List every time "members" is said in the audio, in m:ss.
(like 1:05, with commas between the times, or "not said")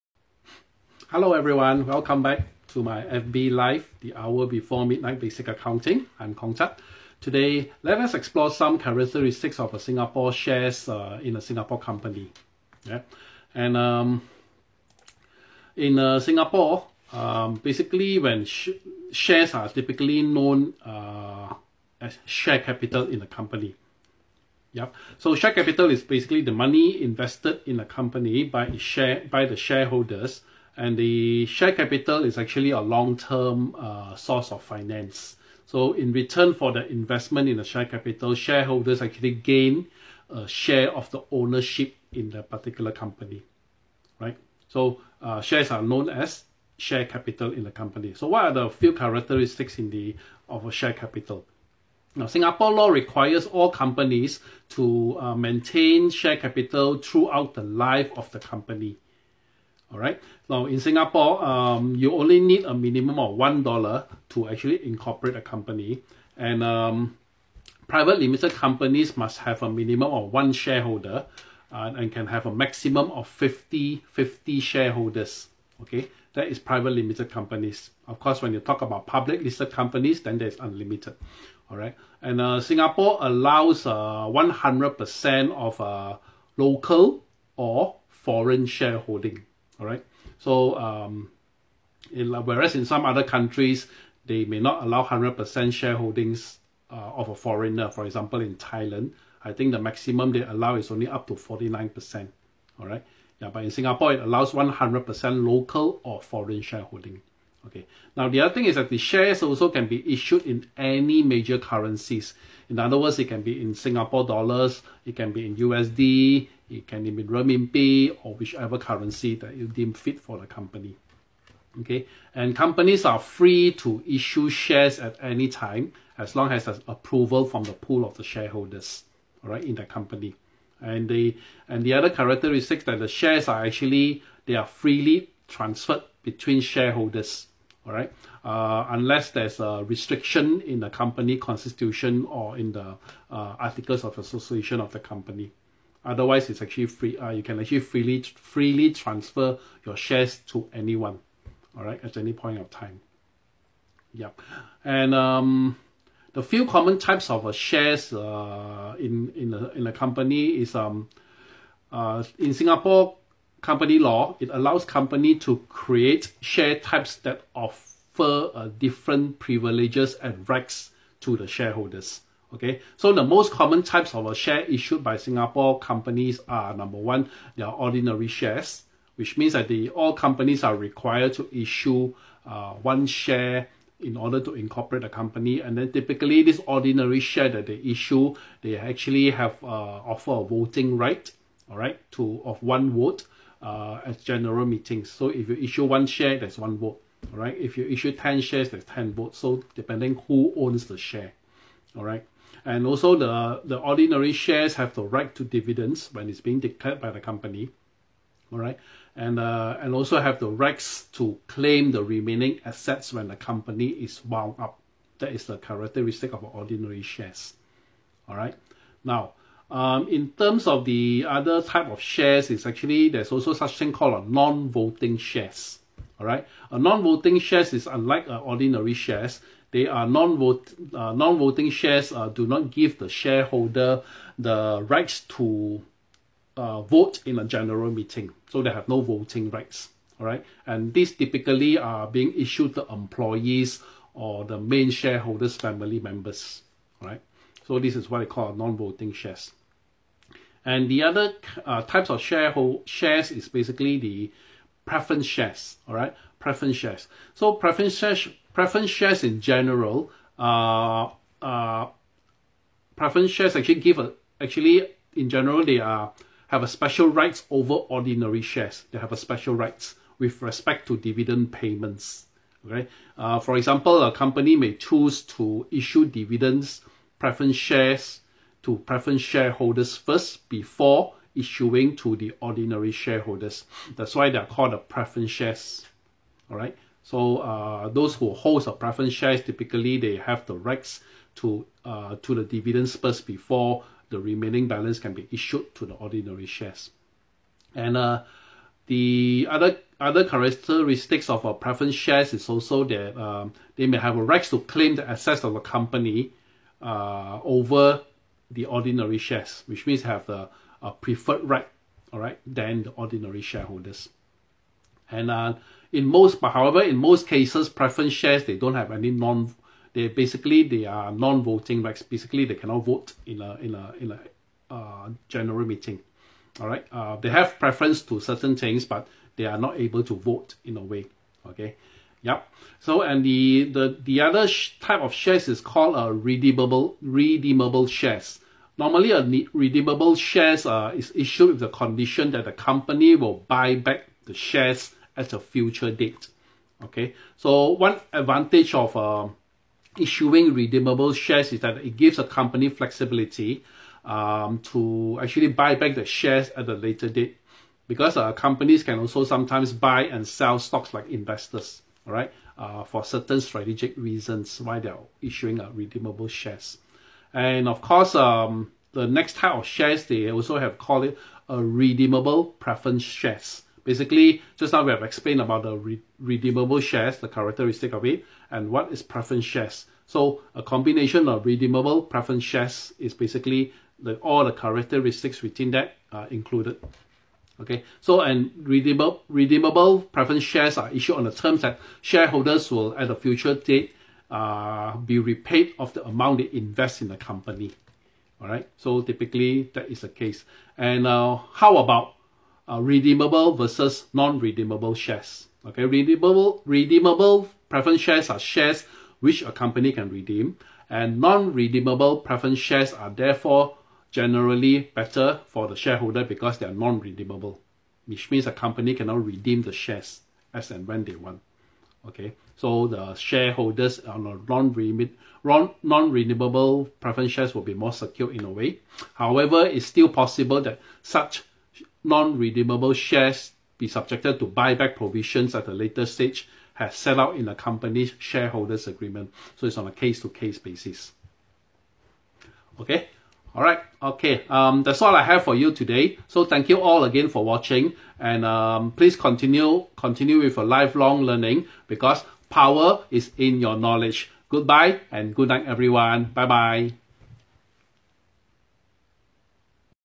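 4:06.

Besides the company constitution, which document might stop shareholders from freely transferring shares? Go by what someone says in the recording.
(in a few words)
Articles of association.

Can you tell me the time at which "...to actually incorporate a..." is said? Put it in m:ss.
1:04.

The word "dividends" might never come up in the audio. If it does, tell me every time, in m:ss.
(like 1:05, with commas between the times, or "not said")
3:25, 4:30, 4:36, 4:52.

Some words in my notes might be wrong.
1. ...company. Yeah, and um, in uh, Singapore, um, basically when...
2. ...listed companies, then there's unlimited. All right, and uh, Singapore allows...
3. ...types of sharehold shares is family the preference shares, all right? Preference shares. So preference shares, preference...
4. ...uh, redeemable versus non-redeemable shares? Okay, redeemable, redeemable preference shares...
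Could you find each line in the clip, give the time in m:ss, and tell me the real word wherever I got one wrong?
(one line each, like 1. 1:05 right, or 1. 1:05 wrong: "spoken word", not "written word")
1. 0:11 right
2. 1:19 right
3. 4:11 wrong: "basically", not "family"
4. 6:42 right.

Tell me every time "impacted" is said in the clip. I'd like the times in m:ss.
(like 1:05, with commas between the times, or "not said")
not said.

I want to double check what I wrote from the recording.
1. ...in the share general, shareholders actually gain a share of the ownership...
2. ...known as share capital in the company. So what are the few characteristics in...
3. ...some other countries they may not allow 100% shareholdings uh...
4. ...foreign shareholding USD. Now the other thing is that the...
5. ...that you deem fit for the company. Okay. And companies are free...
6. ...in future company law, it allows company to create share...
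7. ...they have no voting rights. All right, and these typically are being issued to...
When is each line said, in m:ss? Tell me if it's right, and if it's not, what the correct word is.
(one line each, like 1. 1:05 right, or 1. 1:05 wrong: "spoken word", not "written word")
1. 0:37 wrong: "capital", not "general"
2. 0:45 right
3. 1:32 right
4. 1:46 wrong: "Okay", not "USD"
5. 1:59 right
6. 2:42 wrong: "singapore", not "future"
7. 3:58 right.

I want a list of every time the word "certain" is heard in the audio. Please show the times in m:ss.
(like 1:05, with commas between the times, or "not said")
5:28, 6:03.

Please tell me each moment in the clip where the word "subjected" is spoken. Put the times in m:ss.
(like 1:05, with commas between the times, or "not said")
7:13.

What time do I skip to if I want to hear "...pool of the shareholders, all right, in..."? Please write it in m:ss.
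2:07.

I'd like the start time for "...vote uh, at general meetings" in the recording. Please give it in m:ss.
3:12.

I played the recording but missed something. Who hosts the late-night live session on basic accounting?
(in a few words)
Kong Tat.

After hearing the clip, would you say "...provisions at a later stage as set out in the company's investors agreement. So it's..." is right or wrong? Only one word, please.
wrong.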